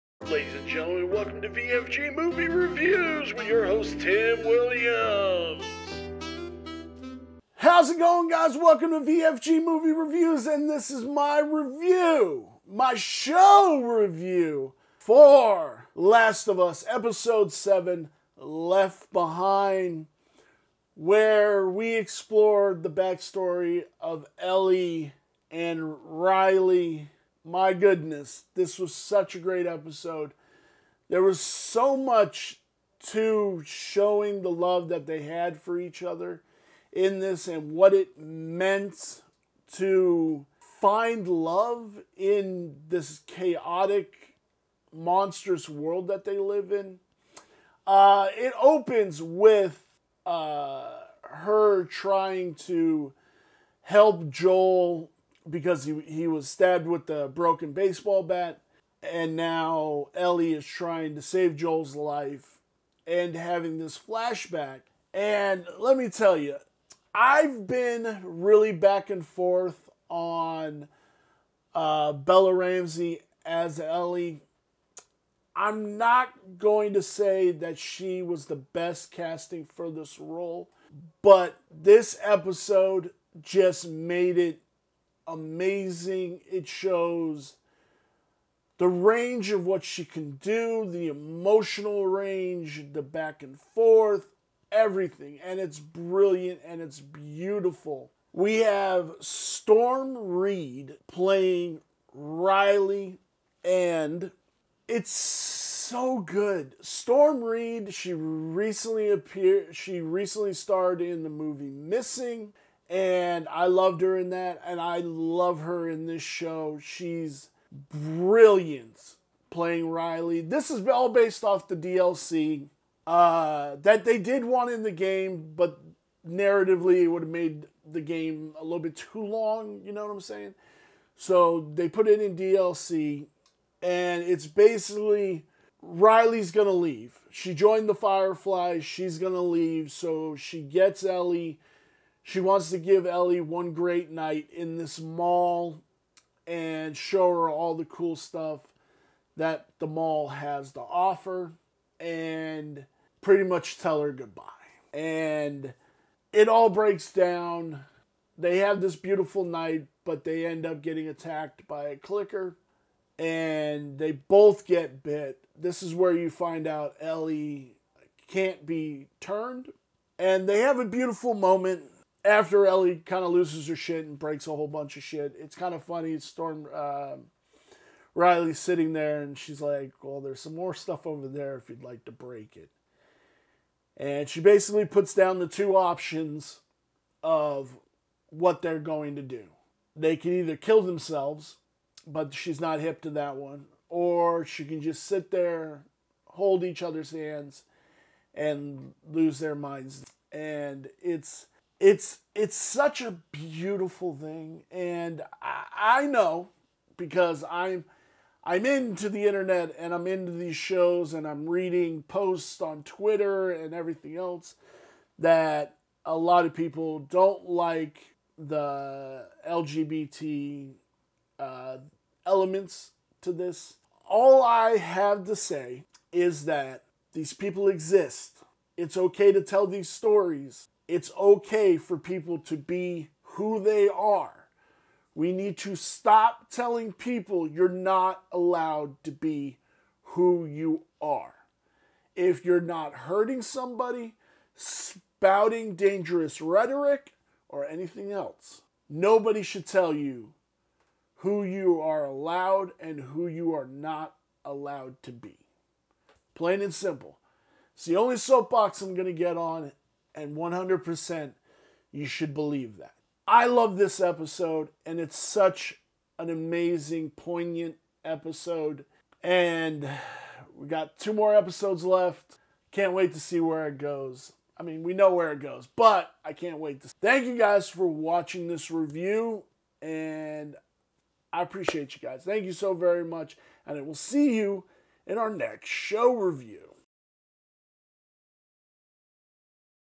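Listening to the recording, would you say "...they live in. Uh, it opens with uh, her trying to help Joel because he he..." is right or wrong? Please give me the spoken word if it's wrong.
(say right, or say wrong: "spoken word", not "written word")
right.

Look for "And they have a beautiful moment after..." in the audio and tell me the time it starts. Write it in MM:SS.
02:50.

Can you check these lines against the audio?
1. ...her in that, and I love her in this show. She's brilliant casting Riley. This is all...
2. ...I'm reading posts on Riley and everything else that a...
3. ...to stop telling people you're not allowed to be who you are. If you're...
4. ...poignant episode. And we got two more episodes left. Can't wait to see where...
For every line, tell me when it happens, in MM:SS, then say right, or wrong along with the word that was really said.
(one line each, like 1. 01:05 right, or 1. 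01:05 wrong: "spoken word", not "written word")
1. 01:54 wrong: "playing", not "casting"
2. 03:31 wrong: "Twitter", not "Riley"
3. 03:55 right
4. 04:27 right.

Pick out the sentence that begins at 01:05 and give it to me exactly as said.
And let me tell you, I've been really back and forth on uh, Bella Ramsey as Ellie.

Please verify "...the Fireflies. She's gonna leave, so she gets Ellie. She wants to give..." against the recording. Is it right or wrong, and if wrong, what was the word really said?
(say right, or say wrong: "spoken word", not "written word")
right.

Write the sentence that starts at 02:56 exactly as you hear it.
Storm uh, Riley's sitting there and she's like, Well, there's some more stuff over there if you'd like to break it.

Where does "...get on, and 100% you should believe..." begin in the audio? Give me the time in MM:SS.
04:19.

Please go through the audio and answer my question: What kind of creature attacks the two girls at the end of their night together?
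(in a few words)
A clicker.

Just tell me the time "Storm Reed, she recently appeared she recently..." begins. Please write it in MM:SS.
01:46.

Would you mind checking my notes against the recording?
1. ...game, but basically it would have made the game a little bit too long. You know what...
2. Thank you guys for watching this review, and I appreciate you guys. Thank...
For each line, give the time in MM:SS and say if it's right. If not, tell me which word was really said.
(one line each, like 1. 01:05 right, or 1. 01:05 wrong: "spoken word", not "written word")
1. 02:04 wrong: "narratively", not "basically"
2. 04:37 right.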